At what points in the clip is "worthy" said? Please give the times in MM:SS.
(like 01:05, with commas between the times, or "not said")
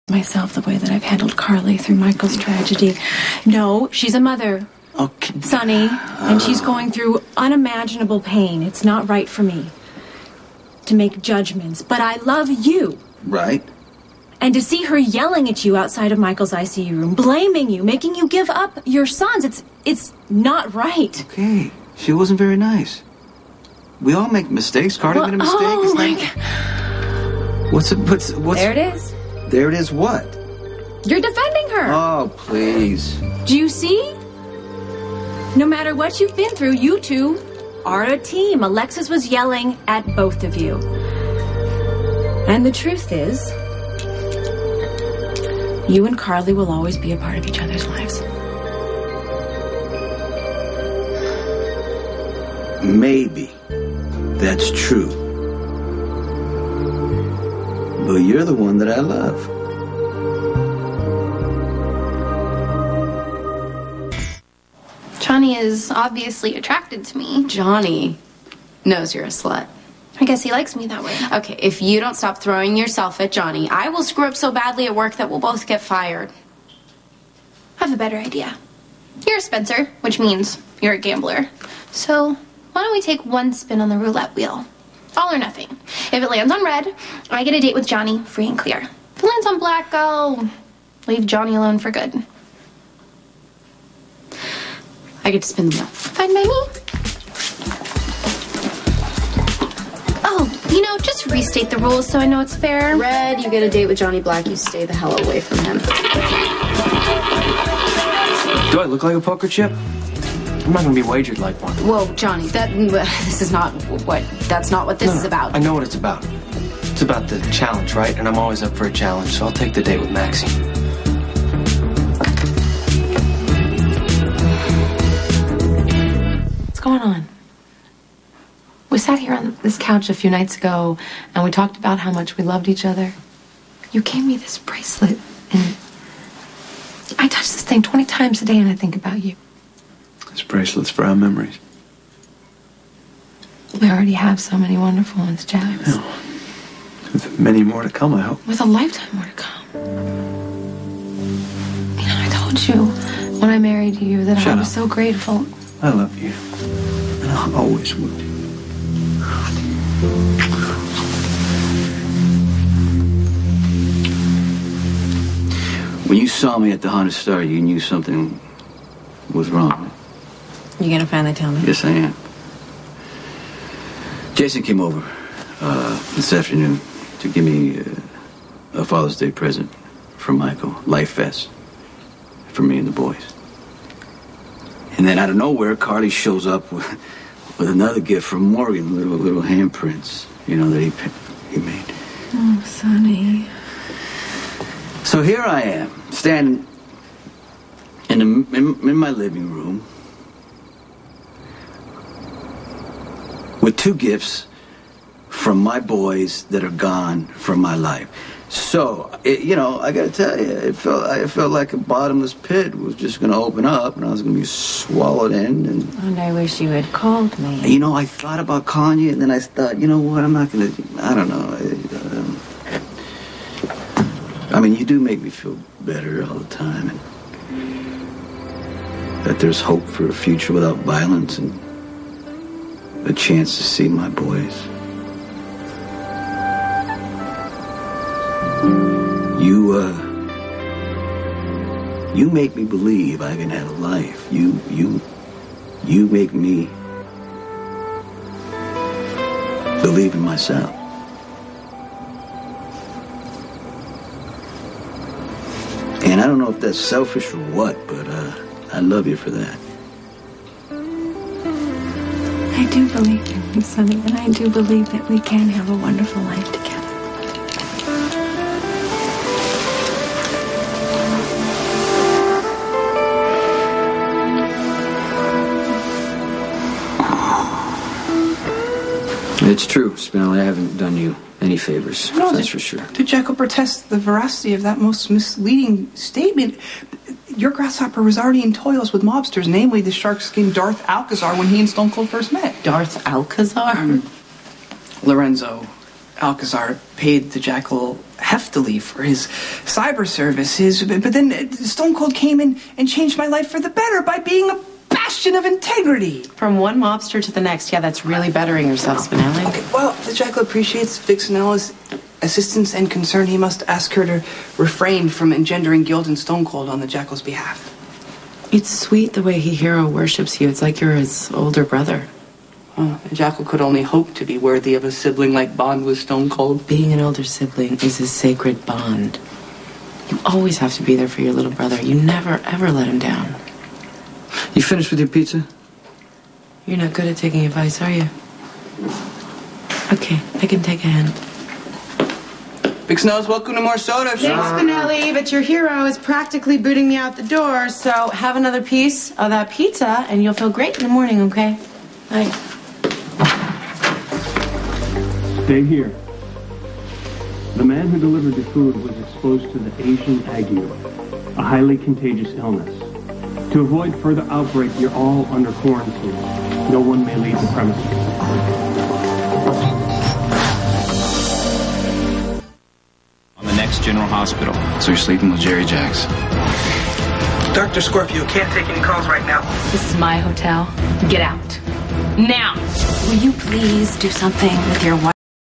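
05:24.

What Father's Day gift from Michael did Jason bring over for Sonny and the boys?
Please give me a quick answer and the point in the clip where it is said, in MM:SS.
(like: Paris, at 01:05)
life vest, at 03:00.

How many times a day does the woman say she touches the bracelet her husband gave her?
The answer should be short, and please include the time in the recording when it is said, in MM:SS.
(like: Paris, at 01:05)
20, at 02:17.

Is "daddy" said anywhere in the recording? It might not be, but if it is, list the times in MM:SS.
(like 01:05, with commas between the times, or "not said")
not said.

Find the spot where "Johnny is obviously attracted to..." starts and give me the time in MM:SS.
01:05.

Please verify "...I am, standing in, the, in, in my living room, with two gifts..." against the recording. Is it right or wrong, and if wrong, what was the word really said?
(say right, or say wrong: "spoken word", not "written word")
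right.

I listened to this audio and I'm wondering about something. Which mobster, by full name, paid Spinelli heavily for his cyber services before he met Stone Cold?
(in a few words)
Lorenzo Alcazar.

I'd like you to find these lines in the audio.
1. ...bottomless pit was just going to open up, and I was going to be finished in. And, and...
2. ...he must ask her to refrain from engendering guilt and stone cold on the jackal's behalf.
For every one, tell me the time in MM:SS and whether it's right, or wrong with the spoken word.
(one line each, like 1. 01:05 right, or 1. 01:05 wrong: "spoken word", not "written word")
1. 03:31 wrong: "swallowed", not "finished"
2. 05:13 right.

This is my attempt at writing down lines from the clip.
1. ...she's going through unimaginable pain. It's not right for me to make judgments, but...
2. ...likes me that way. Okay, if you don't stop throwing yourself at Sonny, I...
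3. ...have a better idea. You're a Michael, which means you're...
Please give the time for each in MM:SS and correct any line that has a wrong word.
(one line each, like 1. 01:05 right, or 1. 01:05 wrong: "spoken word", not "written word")
1. 00:06 right
2. 01:10 wrong: "Johnny", not "Sonny"
3. 01:17 wrong: "Spencer", not "Michael".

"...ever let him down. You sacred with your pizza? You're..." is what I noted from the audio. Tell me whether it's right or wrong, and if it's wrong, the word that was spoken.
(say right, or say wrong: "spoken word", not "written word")
wrong: "finished", not "sacred".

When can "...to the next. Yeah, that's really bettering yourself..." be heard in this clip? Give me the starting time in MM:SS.
05:07.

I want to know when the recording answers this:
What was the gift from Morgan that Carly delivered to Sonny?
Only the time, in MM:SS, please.
03:09.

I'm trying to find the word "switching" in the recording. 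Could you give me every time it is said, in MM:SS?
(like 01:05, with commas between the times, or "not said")
not said.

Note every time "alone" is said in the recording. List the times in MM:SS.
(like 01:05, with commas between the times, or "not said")
01:31.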